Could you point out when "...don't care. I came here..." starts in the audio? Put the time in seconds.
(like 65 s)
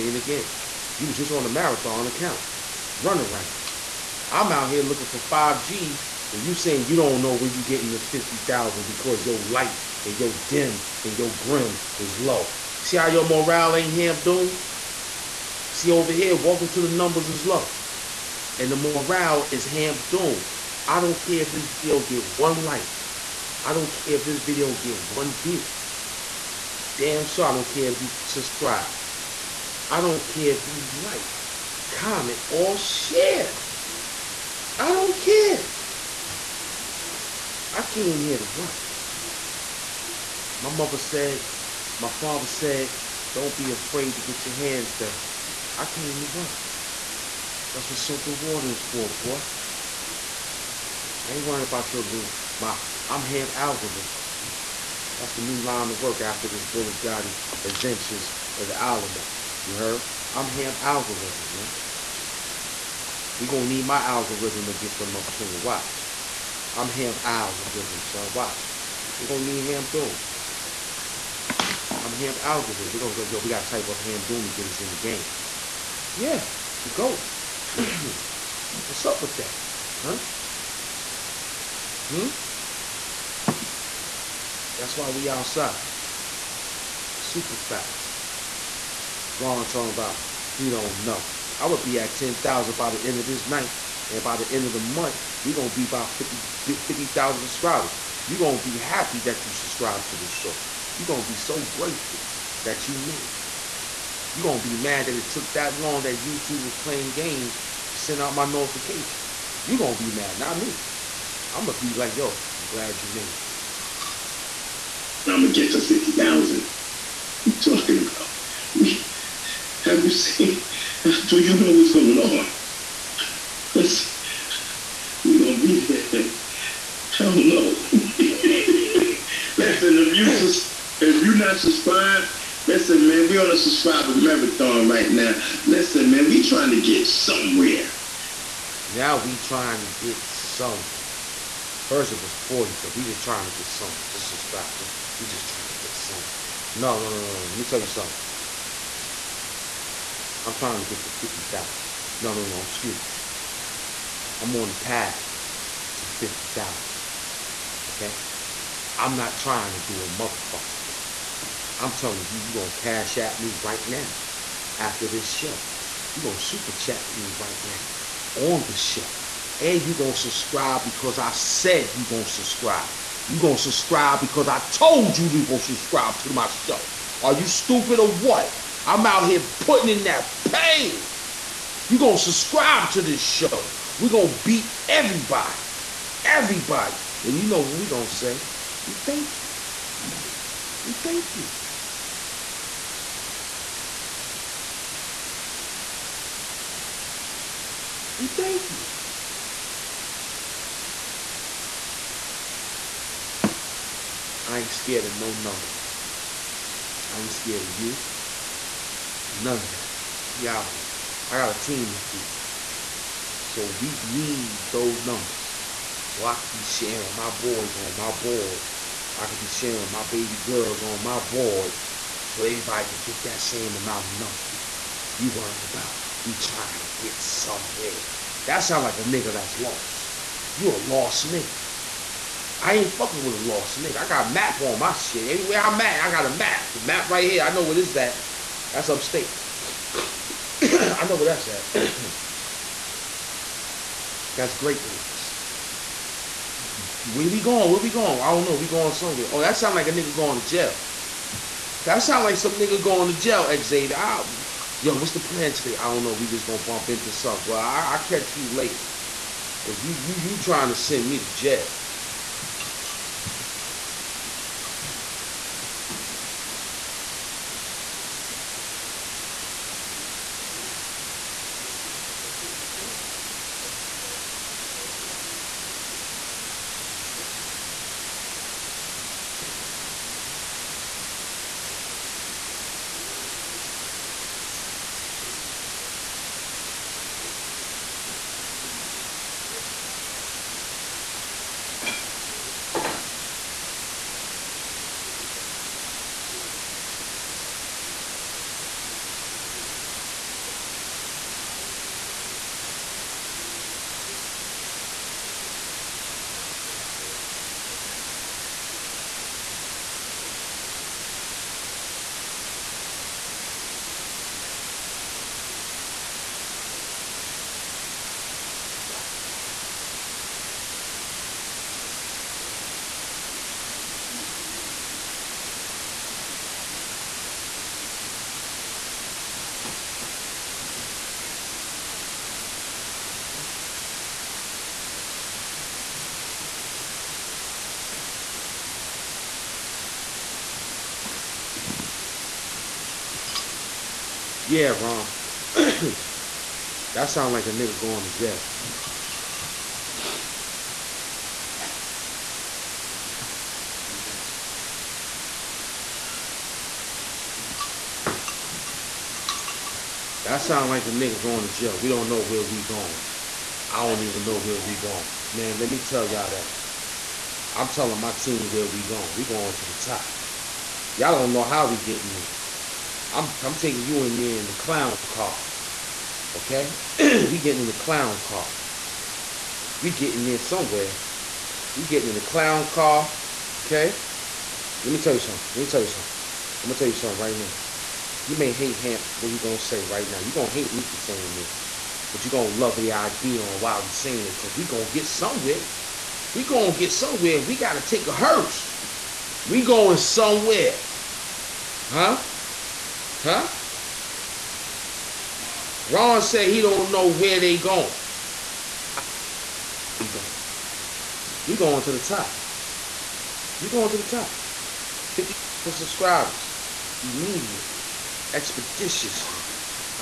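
34 s.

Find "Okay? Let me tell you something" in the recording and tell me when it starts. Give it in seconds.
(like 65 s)
383 s.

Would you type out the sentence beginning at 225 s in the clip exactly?
You worrying about we trying to get somewhere.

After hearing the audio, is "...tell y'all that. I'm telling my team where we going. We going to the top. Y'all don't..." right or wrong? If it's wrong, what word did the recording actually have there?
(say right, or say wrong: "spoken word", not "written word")
right.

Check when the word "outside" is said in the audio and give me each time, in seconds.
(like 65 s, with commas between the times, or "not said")
85 s.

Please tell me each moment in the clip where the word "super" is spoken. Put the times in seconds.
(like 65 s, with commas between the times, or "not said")
87 s, 166 s.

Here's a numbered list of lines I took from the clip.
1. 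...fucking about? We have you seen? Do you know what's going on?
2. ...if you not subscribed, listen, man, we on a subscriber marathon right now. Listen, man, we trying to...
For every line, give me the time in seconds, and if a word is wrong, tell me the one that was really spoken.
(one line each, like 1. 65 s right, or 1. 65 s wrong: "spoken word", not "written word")
1. 117 s wrong: "talking", not "fucking"
2. 130 s right.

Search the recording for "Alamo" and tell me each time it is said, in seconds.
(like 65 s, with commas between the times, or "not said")
58 s.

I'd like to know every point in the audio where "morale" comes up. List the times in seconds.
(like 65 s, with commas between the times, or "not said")
13 s, 18 s.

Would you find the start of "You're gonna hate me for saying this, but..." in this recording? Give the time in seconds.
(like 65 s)
390 s.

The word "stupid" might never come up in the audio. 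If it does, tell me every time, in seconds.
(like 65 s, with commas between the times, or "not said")
177 s.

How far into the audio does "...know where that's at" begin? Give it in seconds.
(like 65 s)
241 s.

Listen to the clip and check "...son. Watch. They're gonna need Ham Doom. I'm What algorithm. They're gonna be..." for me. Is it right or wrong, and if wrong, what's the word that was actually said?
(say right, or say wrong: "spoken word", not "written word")
wrong: "Ham", not "What".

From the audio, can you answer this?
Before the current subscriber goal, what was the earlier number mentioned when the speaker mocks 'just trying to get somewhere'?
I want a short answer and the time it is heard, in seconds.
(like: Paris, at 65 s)
40, at 142 s.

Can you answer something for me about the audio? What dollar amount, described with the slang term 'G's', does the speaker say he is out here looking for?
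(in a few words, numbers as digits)
5 G's.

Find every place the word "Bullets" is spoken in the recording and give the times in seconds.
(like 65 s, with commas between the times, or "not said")
56 s.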